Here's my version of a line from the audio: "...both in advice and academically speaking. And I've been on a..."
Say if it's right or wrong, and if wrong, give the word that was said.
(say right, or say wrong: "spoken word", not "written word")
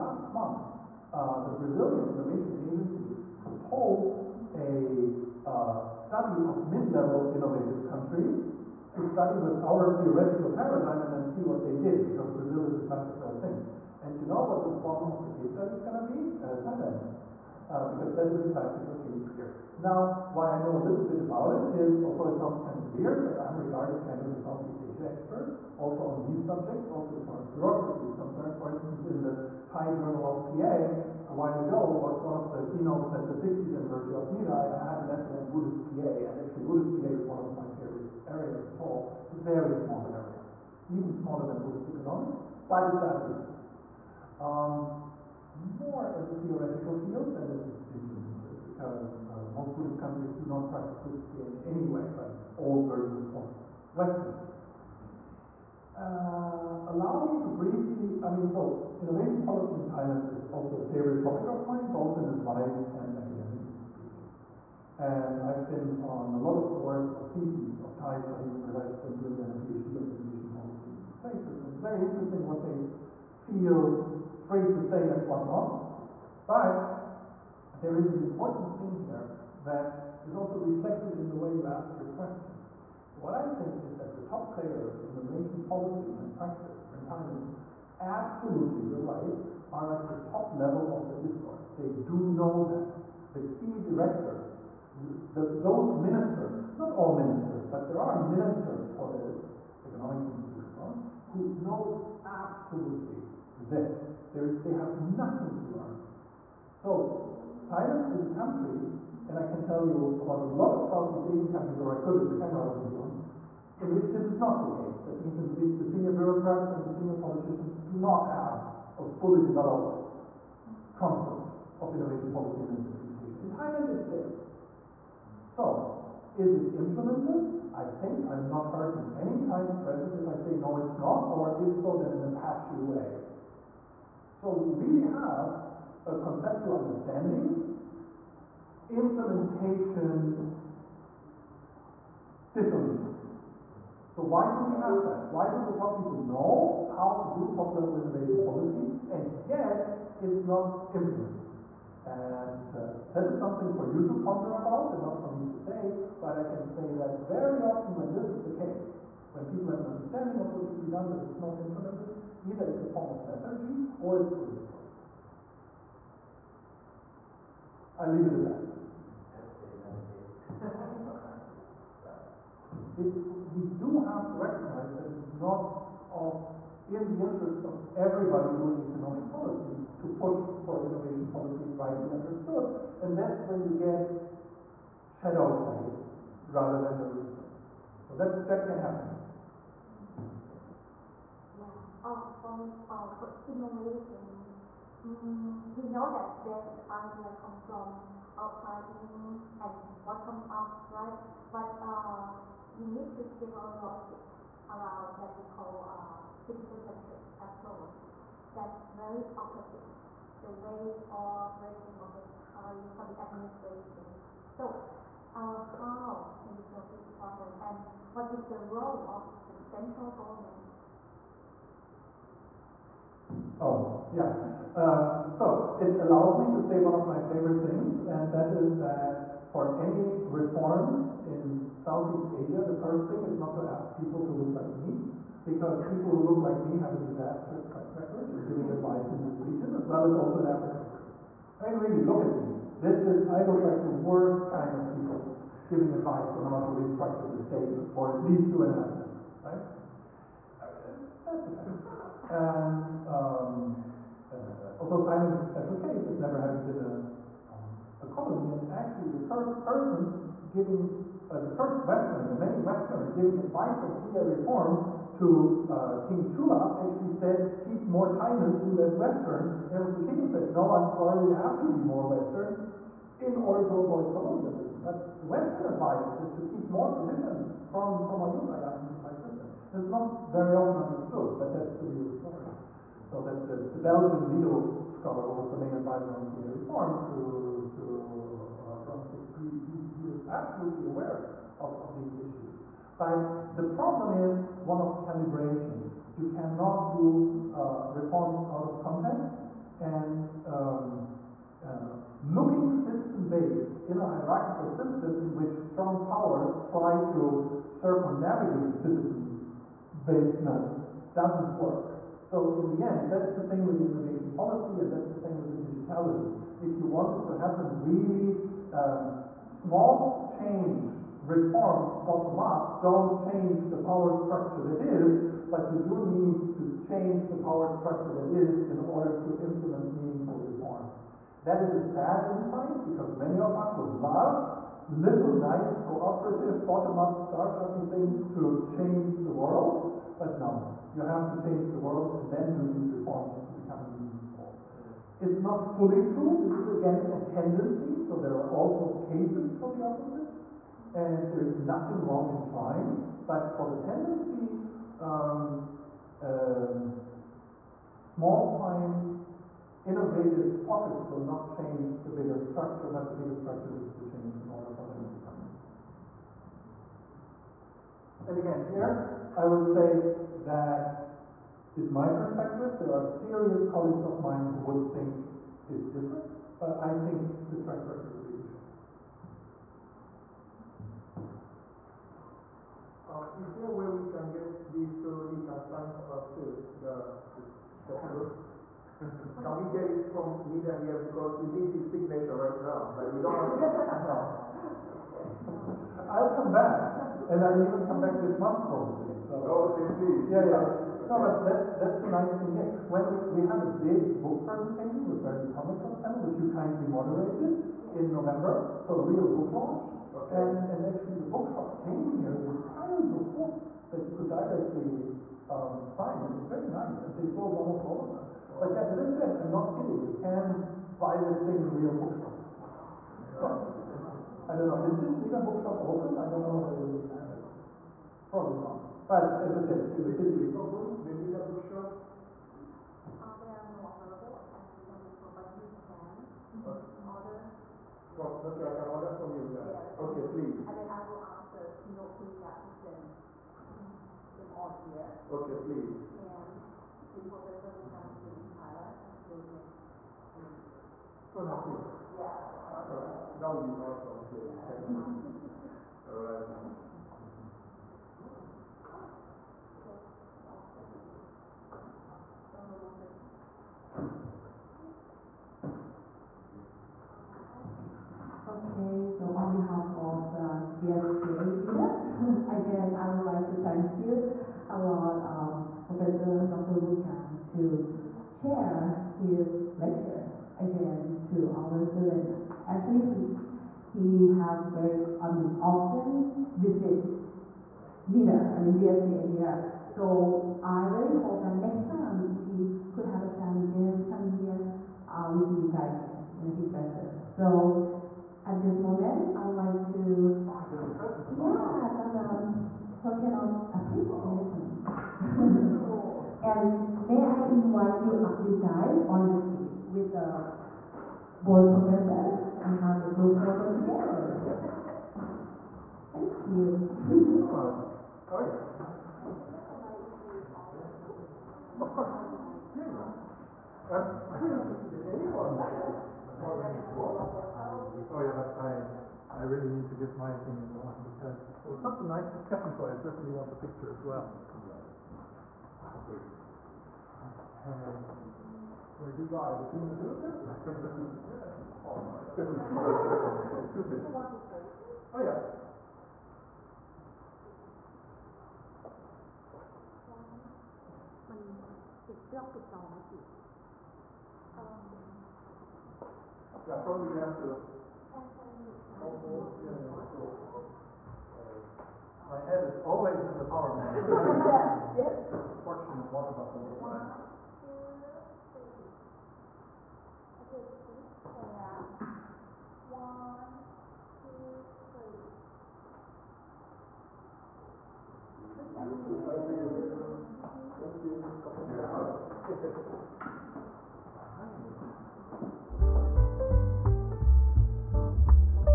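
right.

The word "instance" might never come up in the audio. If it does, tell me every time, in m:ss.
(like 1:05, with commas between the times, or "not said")
0:28, 4:01.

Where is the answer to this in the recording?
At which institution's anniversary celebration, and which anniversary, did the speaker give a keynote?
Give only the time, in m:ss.
0:33.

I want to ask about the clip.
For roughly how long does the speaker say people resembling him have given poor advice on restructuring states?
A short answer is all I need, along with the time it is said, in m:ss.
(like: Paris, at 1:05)
two and a half centuries, at 4:08.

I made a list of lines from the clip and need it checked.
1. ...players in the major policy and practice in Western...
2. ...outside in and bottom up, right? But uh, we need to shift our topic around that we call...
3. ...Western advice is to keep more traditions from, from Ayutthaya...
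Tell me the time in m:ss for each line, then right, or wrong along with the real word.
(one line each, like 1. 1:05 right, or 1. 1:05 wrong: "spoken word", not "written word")
1. 1:24 wrong: "Thailand", not "Western"
2. 3:18 wrong: "logic", not "topic"
3. 4:35 right.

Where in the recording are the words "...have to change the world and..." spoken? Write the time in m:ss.
5:41.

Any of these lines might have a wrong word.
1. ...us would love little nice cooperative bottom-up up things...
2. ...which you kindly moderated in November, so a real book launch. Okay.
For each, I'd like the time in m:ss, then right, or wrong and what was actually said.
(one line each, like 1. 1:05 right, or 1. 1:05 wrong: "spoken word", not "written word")
1. 5:33 right
2. 6:46 right.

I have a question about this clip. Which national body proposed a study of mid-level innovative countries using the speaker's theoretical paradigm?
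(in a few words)
Brazilian Innovation Agency.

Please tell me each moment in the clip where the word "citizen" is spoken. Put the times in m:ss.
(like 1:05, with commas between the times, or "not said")
3:26, 5:02, 5:08.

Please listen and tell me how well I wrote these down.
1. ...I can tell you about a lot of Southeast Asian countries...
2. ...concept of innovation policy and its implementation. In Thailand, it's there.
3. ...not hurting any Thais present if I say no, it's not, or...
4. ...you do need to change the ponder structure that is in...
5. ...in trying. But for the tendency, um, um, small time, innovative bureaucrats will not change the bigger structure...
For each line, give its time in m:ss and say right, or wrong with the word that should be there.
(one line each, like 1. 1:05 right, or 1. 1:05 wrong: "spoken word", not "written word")
1. 1:49 right
2. 2:00 right
3. 2:08 right
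4. 5:25 wrong: "power", not "ponder"
5. 5:52 wrong: "pockets", not "bureaucrats".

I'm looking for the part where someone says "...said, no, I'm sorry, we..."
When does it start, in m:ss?
4:30.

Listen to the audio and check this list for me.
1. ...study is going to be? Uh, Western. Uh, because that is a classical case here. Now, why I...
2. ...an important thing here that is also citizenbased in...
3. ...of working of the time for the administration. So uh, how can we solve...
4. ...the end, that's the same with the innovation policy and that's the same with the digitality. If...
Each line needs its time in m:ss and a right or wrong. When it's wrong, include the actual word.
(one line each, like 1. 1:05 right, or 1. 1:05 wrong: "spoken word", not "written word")
1. 0:15 wrong: "Thailand", not "Western"
2. 1:18 wrong: "reflected", not "citizenbased"
3. 3:31 right
4. 5:12 right.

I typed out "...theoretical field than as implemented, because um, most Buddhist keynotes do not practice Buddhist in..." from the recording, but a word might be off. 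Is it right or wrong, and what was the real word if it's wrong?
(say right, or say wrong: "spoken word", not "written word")
wrong: "countries", not "keynotes".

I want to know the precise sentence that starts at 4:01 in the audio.
I mean, really, look at me.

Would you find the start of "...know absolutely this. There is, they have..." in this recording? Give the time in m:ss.
1:41.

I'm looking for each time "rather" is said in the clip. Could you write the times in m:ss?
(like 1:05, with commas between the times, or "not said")
3:06.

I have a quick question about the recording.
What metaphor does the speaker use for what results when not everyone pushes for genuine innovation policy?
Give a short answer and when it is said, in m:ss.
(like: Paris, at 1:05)
shadow play, at 3:05.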